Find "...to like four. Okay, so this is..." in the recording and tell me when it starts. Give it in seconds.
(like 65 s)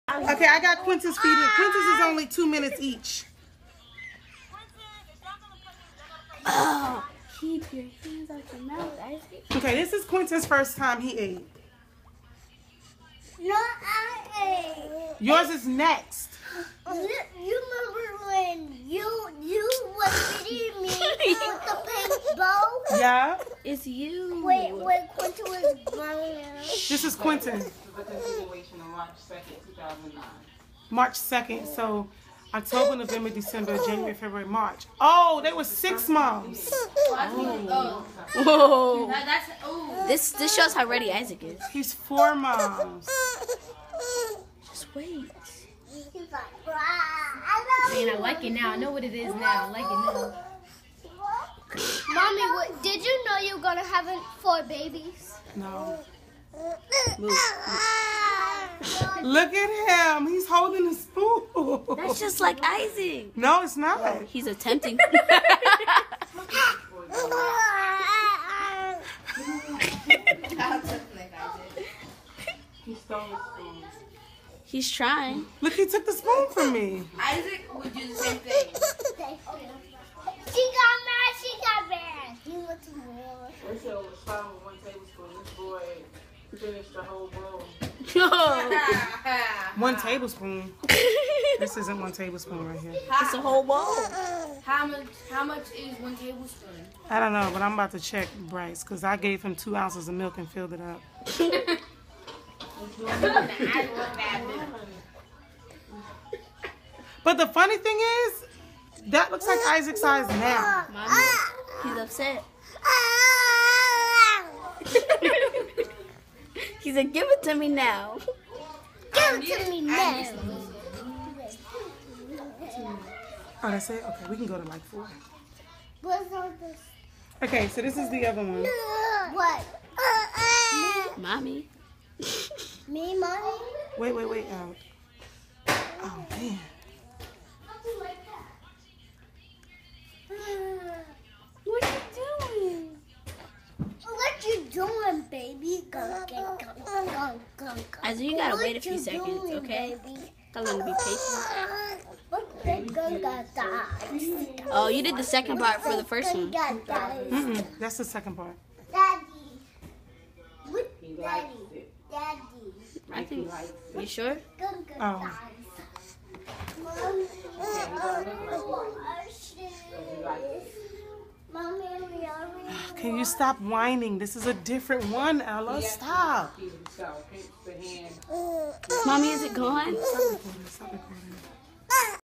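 124 s.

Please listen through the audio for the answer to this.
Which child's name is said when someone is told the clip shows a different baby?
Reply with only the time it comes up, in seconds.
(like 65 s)
175 s.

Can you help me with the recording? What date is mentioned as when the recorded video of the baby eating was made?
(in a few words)
March 2nd, 2009.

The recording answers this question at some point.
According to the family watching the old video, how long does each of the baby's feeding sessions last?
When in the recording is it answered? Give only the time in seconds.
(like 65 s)
2 s.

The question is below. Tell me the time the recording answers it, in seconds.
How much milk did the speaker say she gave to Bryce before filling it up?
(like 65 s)
99 s.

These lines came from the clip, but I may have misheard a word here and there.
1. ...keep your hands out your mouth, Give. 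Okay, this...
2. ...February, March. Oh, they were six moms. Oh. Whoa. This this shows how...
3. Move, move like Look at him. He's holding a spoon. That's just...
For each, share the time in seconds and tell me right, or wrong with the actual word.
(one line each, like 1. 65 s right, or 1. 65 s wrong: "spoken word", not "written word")
1. 7 s wrong: "Isaac", not "Give"
2. 34 s right
3. 56 s right.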